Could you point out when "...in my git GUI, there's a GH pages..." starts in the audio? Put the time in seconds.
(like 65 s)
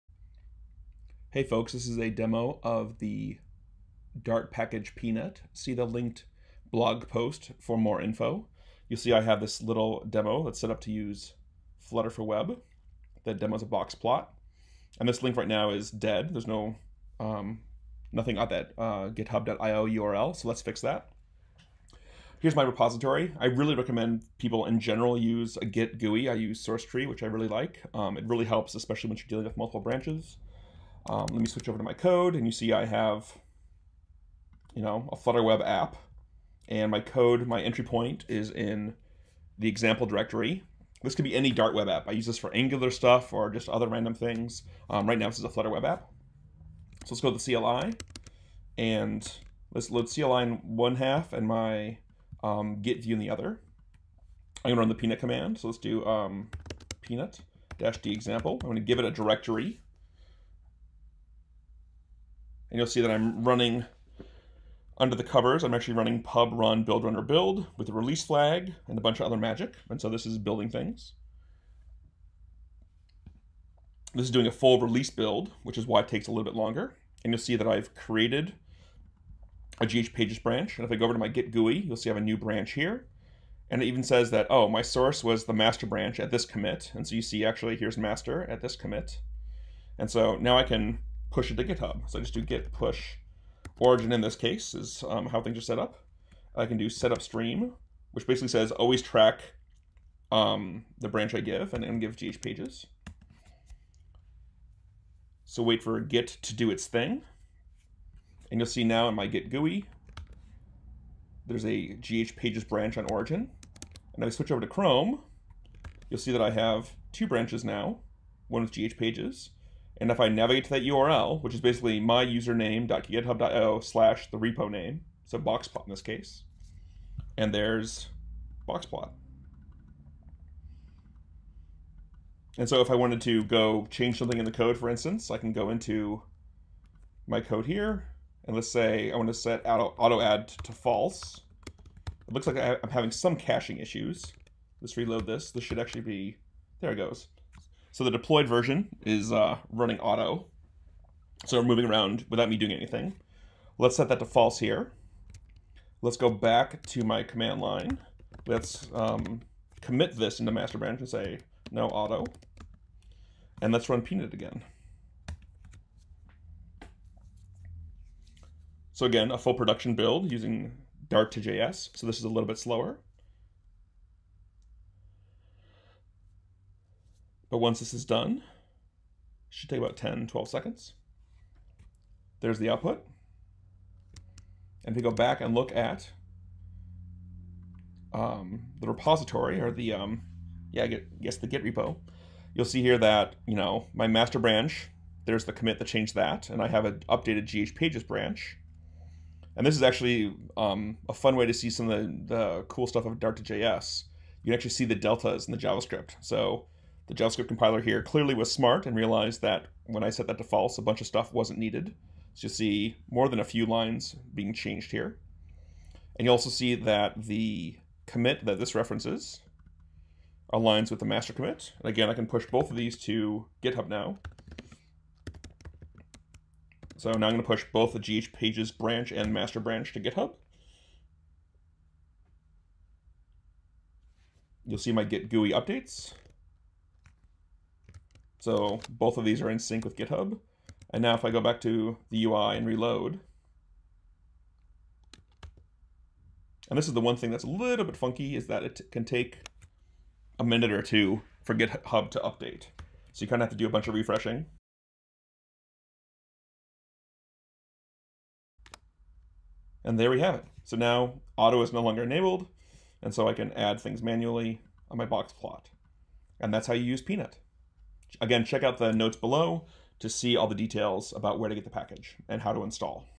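109 s.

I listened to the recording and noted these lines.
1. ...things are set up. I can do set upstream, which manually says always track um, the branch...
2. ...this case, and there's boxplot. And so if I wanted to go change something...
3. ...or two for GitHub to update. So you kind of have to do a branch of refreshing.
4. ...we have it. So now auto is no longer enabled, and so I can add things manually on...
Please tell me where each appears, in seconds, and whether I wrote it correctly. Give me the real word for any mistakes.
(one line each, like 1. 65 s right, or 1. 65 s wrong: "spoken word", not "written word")
1. 95 s wrong: "basically", not "manually"
2. 125 s right
3. 250 s wrong: "bunch", not "branch"
4. 260 s right.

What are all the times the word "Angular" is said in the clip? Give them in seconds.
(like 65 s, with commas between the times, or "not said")
42 s.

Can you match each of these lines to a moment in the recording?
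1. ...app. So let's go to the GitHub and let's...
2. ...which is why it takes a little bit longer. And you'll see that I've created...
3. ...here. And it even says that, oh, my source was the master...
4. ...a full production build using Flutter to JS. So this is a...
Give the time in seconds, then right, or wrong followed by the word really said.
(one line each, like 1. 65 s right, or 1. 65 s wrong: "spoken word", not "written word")
1. 45 s wrong: "CLI", not "GitHub"
2. 75 s right
3. 82 s right
4. 169 s wrong: "Dart", not "Flutter".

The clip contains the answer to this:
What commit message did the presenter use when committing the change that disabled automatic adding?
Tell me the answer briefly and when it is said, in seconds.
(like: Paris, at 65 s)
no auto, at 161 s.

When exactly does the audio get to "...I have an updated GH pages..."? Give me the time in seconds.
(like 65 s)
196 s.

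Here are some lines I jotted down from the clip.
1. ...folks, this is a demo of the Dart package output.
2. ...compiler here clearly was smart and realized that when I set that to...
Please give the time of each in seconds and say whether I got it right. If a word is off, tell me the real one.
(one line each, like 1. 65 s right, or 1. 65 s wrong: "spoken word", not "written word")
1. 1 s wrong: "peanut", not "output"
2. 207 s right.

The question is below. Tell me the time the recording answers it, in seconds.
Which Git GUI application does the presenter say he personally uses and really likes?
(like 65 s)
26 s.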